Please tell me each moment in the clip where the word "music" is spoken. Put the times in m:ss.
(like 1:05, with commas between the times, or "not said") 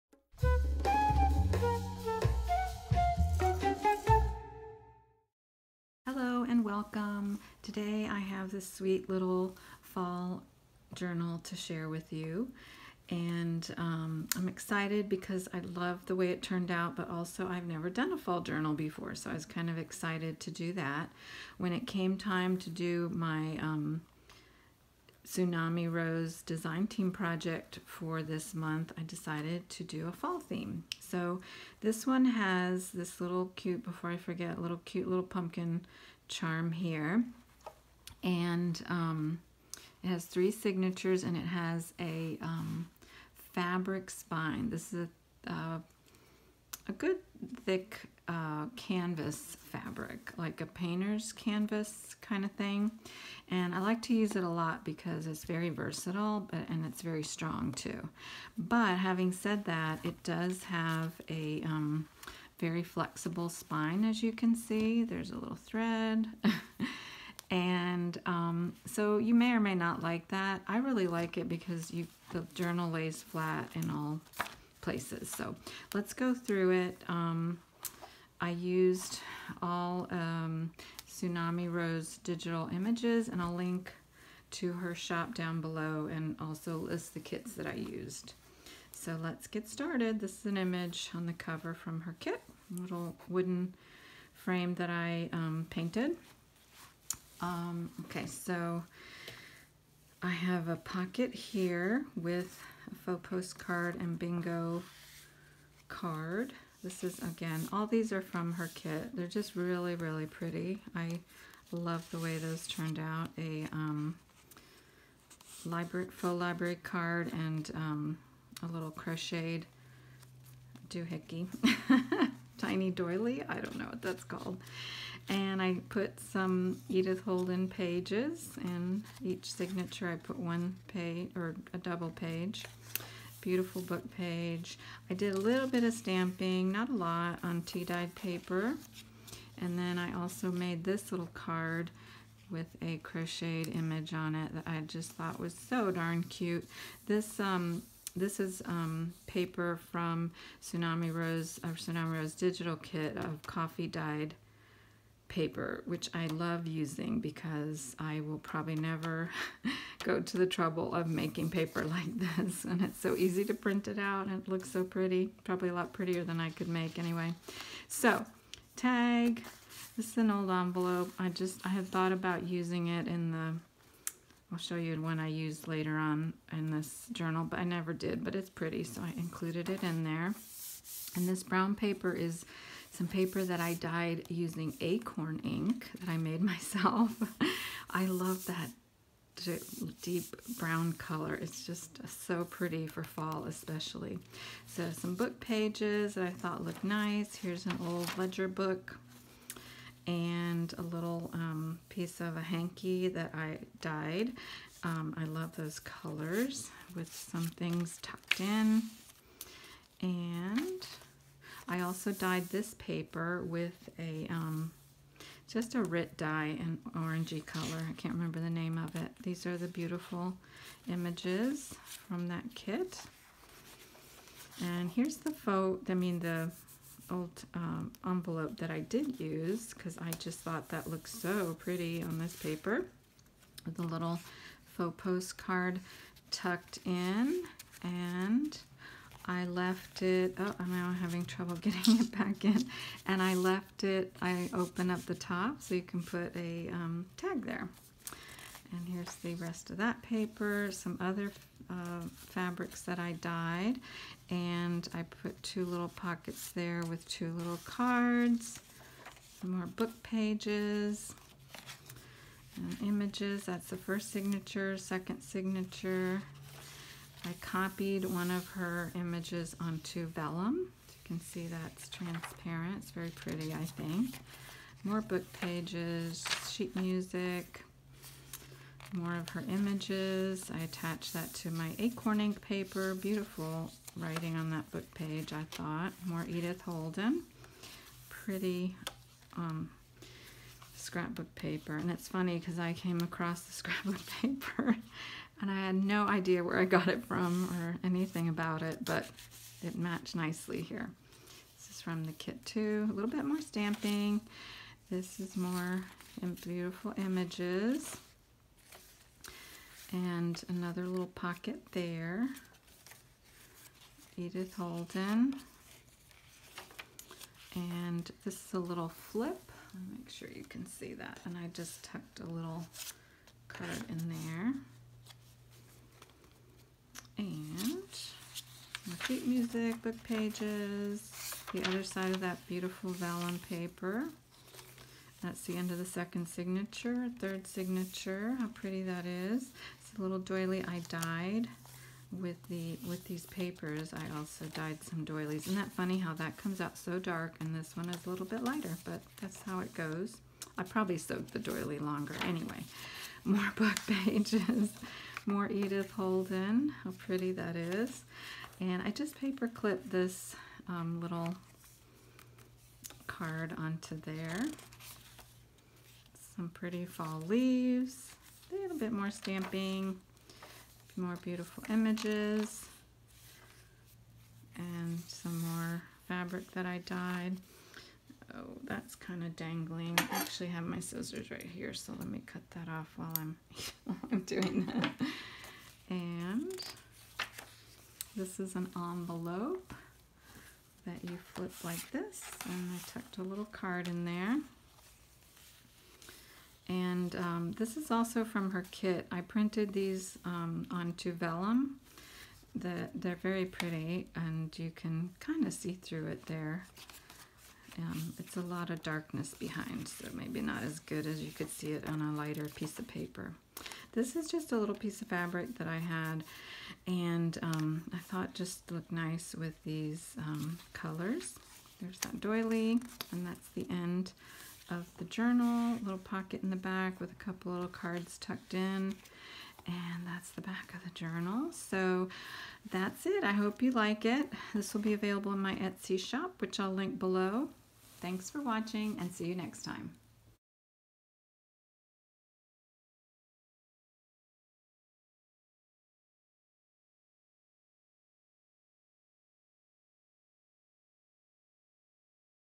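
4:36, 5:29.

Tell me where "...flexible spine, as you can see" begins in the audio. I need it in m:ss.
1:02.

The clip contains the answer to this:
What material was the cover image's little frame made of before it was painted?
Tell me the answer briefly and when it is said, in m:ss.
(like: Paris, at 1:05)
wooden, at 1:33.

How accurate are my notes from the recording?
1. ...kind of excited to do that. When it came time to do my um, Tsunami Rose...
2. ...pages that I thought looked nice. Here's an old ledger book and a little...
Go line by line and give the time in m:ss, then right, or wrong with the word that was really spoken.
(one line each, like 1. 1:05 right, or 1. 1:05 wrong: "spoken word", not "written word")
1. 0:19 right
2. 3:15 right.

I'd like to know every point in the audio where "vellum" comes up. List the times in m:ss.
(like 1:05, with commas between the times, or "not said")
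4:30, 5:32, 6:41.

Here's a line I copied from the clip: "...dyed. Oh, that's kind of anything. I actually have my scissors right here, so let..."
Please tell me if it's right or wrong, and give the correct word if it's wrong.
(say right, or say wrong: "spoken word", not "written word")
wrong: "dangling", not "anything".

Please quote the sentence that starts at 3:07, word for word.
I love that deep brown color.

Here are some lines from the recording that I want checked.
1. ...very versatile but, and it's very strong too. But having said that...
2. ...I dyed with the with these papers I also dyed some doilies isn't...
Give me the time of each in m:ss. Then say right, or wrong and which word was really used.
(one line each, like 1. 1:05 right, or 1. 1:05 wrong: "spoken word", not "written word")
1. 0:55 right
2. 5:40 right.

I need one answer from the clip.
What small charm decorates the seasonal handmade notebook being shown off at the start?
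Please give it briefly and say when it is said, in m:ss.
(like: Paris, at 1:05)
pumpkin charm, at 0:35.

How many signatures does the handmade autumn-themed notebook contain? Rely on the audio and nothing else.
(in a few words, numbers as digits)
3.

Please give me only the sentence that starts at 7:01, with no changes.
There's that doily, and that's the end of the journal, little pocket in the back with a couple little cards tucked in.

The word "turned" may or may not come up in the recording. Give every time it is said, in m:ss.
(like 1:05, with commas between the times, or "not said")
0:16, 1:52.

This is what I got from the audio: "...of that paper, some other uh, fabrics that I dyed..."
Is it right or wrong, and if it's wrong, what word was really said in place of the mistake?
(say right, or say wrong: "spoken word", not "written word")
right.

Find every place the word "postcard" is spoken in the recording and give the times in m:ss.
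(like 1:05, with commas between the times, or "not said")
1:43, 3:54.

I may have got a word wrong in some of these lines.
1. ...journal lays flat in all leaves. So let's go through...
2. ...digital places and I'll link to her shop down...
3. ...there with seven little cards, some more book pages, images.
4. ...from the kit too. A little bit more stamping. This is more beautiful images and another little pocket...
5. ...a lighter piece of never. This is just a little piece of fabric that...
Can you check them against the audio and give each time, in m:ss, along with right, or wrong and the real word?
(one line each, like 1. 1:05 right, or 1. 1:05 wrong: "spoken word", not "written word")
1. 1:12 wrong: "places", not "leaves"
2. 1:22 wrong: "images", not "places"
3. 4:16 wrong: "two", not "seven"
4. 5:01 right
5. 6:52 wrong: "paper", not "never".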